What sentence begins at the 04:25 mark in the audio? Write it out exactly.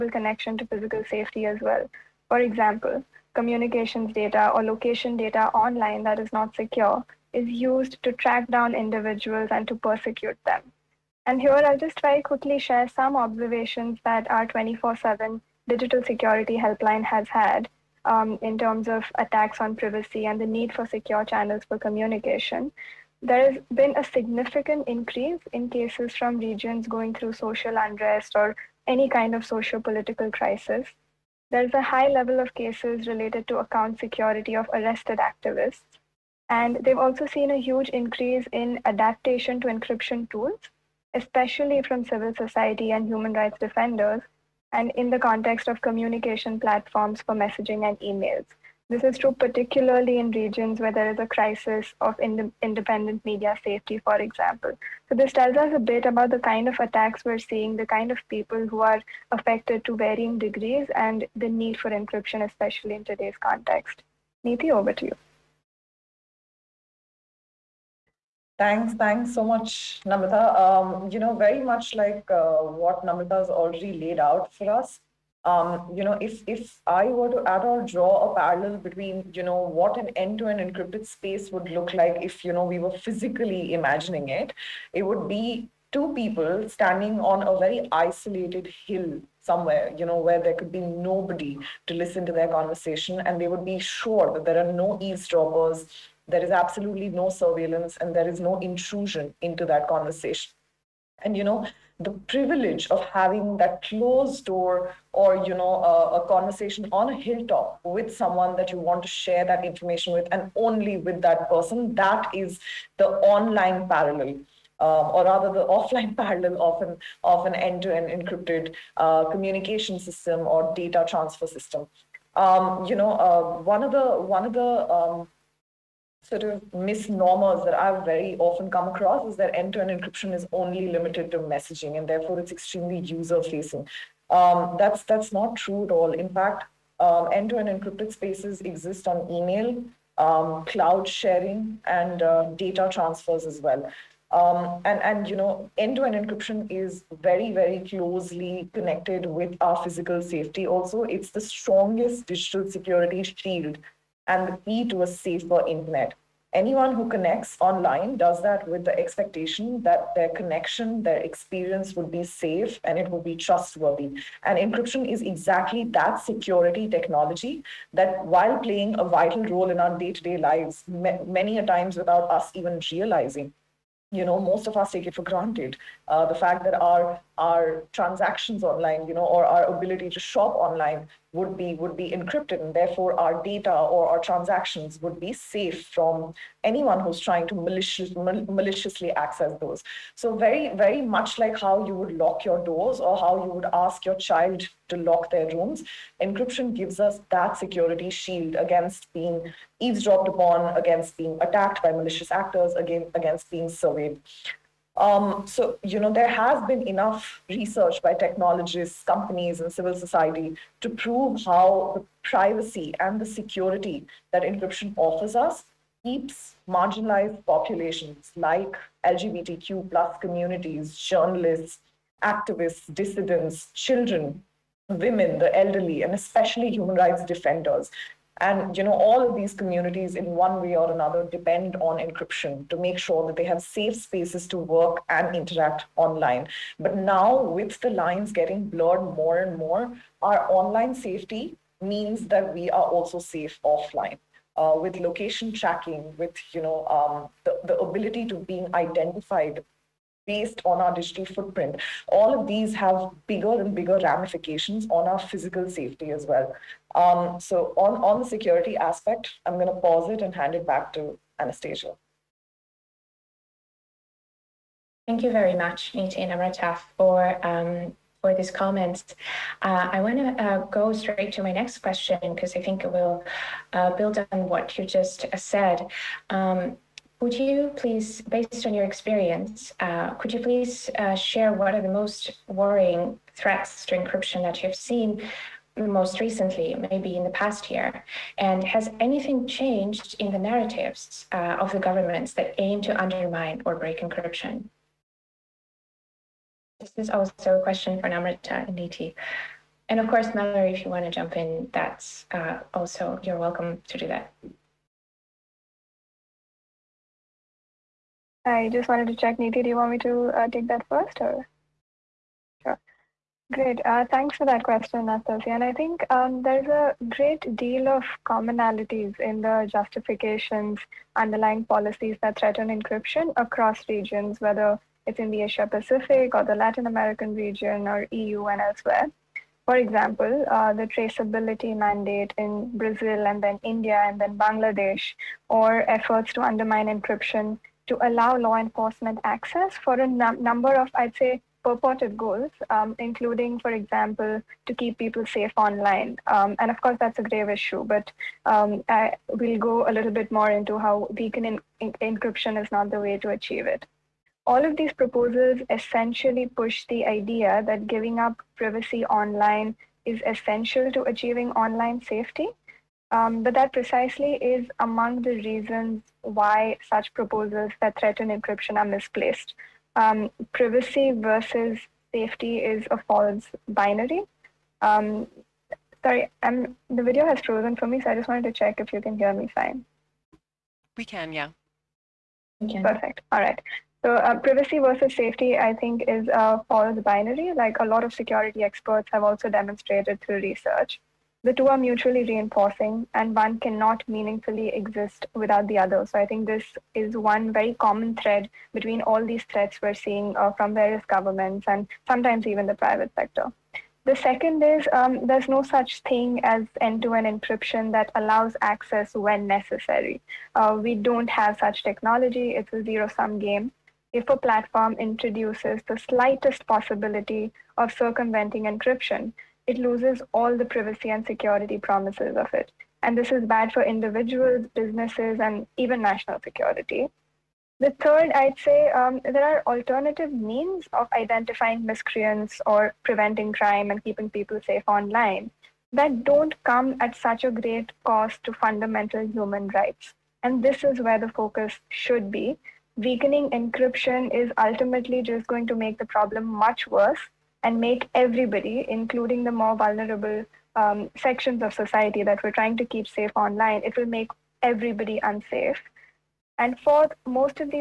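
Thank you very much, Neeti and Amrita, for um, for these comments.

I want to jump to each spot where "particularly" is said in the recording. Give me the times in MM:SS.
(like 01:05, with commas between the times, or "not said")
00:49.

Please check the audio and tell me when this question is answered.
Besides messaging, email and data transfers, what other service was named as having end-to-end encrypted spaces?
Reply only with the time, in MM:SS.
02:20.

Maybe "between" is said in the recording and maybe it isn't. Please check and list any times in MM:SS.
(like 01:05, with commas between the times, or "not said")
01:18, 06:38.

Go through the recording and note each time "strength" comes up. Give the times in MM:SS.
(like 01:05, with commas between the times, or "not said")
not said.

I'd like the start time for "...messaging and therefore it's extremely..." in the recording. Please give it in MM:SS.
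02:11.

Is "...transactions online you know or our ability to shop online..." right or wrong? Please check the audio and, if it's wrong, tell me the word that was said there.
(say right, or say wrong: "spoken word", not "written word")
right.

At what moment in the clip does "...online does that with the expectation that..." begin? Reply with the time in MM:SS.
02:37.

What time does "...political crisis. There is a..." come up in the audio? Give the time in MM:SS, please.
00:29.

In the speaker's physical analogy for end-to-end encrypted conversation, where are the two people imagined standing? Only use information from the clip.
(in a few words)
isolated hill.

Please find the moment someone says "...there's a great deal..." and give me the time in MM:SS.
05:16.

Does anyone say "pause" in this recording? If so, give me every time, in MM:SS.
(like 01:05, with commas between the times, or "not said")
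04:19.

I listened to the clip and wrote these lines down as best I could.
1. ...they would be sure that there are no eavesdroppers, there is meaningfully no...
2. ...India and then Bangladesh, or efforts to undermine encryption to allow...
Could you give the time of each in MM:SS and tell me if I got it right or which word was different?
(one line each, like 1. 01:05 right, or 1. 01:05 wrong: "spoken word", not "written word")
1. 01:33 wrong: "absolutely", not "meaningfully"
2. 05:33 right.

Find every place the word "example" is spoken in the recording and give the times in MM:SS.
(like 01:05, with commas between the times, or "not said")
00:02, 00:54, 05:29, 05:43.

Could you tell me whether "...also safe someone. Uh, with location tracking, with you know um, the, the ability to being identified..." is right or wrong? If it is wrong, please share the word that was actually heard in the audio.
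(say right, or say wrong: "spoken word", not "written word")
wrong: "offline", not "someone".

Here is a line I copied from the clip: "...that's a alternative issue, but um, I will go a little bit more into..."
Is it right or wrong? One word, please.
wrong.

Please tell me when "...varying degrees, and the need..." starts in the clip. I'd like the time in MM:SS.
00:59.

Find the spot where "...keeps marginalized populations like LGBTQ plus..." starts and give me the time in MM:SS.
03:36.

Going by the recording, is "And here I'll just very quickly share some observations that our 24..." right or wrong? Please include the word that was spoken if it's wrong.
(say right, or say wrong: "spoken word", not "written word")
right.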